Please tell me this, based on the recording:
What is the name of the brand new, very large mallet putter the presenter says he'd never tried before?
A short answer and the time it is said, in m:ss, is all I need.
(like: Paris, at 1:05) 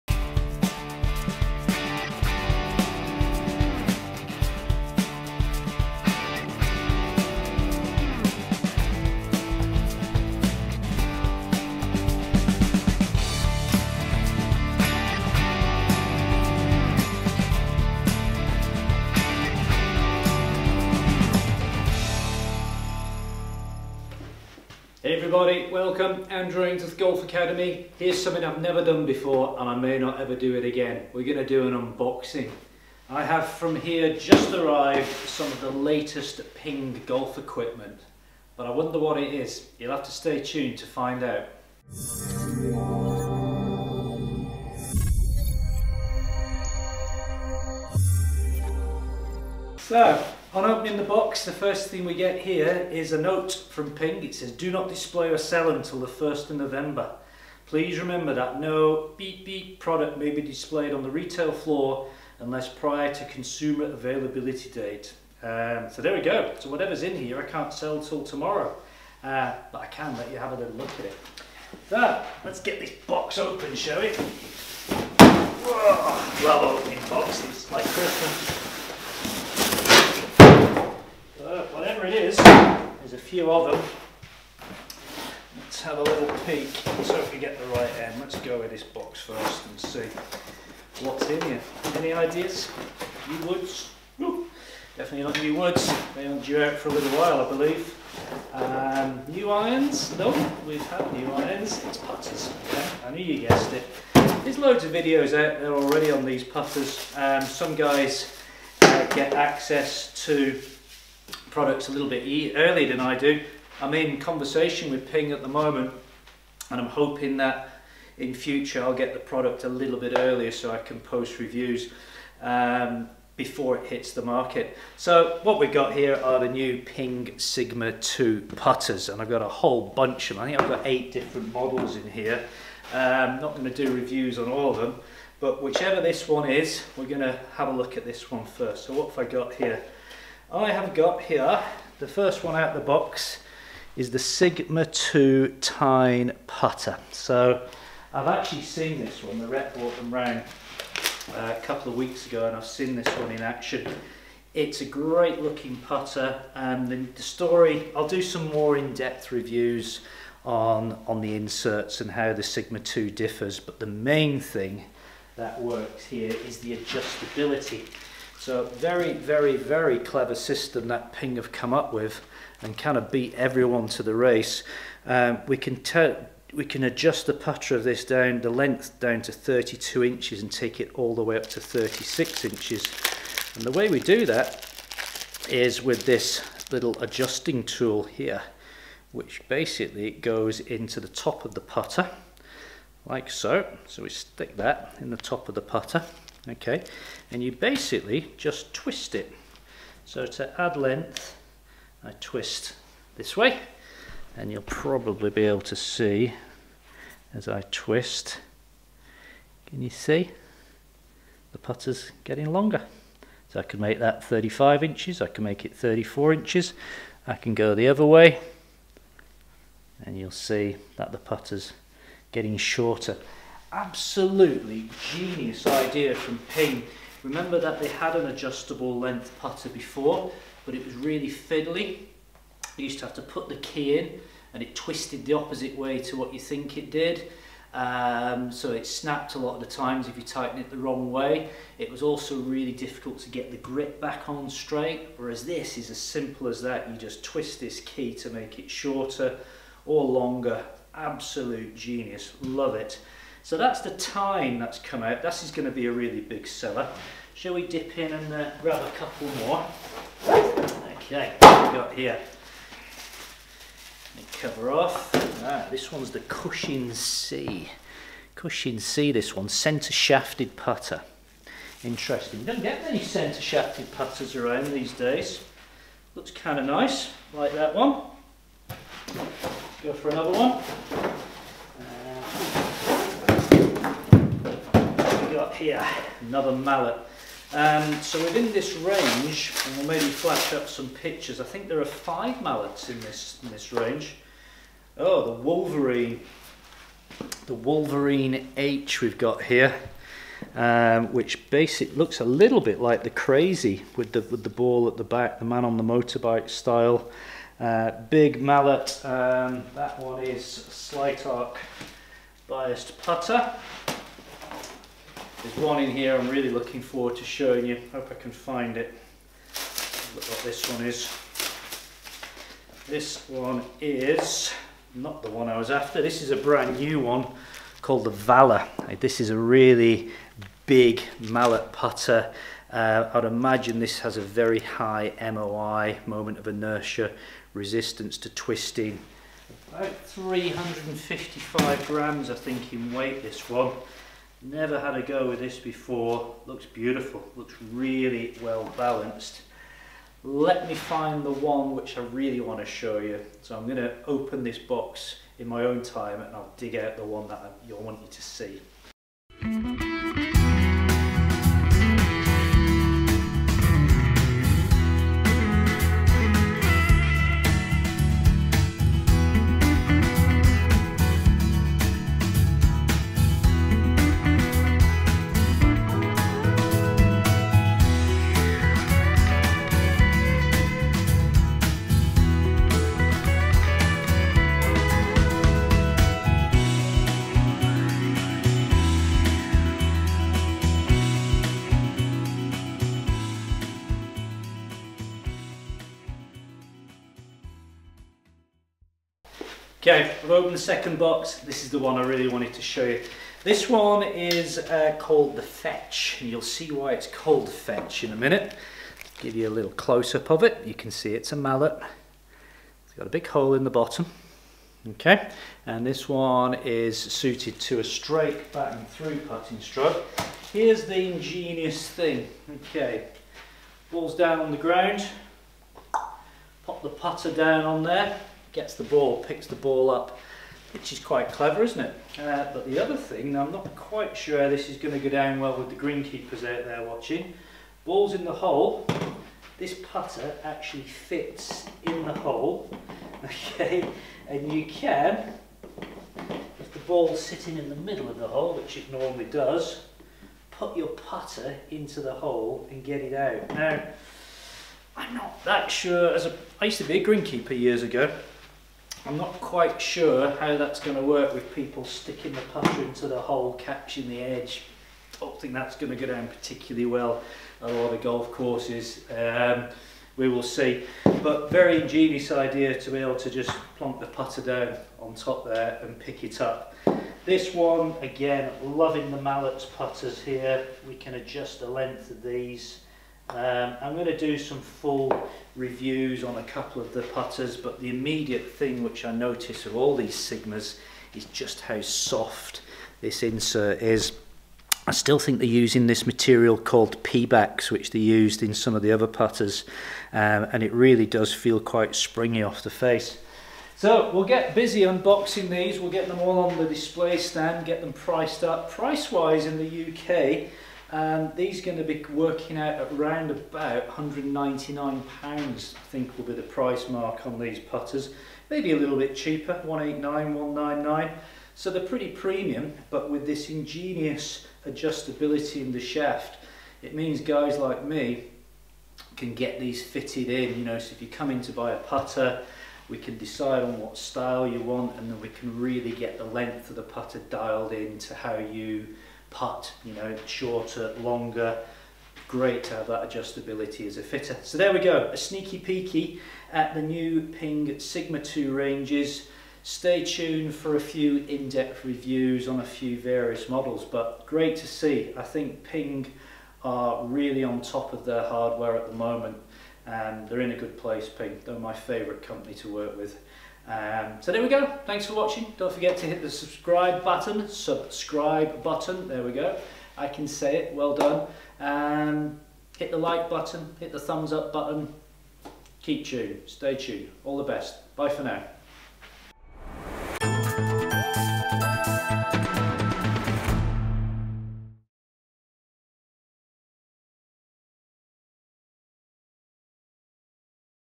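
Valor, at 5:28.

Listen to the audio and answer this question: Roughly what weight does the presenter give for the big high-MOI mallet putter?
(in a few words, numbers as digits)
355 grams.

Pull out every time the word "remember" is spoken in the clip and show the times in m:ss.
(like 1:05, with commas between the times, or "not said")
0:57, 3:47.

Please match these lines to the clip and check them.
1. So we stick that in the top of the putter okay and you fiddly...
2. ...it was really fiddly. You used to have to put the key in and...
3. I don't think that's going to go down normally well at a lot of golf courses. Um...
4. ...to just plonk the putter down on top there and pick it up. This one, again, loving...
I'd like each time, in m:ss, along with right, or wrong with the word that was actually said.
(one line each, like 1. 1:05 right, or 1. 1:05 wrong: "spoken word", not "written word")
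1. 3:13 wrong: "basically", not "fiddly"
2. 3:50 right
3. 7:45 wrong: "particularly", not "normally"
4. 7:53 right.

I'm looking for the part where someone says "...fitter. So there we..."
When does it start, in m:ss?
9:04.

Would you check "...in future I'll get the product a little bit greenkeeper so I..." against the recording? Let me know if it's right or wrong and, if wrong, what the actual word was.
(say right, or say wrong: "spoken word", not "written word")
wrong: "earlier", not "greenkeeper".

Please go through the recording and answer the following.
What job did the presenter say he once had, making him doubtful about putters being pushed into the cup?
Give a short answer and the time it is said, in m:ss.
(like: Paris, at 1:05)
Greenkeeper, at 7:37.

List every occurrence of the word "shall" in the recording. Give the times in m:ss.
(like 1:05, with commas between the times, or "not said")
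1:13, 4:17.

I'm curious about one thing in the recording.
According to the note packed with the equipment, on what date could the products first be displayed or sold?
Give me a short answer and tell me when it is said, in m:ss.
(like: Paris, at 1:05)
1st of November, at 0:56.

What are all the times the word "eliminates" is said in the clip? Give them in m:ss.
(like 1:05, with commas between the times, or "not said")
not said.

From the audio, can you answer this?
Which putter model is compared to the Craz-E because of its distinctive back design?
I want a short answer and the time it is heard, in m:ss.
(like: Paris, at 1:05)
Wolverine H, at 4:57.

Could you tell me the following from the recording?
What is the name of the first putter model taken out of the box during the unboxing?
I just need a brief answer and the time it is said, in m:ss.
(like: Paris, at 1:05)
Sigma 2 Tyne, at 2:24.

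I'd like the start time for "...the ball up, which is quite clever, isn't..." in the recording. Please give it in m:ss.
7:09.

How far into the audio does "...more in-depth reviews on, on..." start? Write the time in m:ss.
2:38.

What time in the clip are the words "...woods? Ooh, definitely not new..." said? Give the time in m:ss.
1:33.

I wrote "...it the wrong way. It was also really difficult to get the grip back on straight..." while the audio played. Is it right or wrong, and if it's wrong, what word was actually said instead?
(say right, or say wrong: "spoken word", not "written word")
right.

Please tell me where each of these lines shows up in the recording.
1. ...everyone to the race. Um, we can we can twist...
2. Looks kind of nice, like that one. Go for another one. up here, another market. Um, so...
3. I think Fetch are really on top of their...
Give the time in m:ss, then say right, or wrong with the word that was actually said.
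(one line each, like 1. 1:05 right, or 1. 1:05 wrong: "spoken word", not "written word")
1. 2:53 wrong: "adjust", not "twist"
2. 4:36 wrong: "mallet", not "market"
3. 9:15 wrong: "Ping", not "Fetch".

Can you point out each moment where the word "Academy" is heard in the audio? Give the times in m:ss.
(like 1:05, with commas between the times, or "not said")
0:27.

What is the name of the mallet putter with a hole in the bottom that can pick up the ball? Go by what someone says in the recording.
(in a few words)
The Fetch.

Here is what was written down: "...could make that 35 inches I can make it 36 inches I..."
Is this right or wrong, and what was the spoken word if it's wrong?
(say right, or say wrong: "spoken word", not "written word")
wrong: "34", not "36".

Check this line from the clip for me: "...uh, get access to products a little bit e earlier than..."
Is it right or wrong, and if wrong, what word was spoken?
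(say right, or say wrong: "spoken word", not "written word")
right.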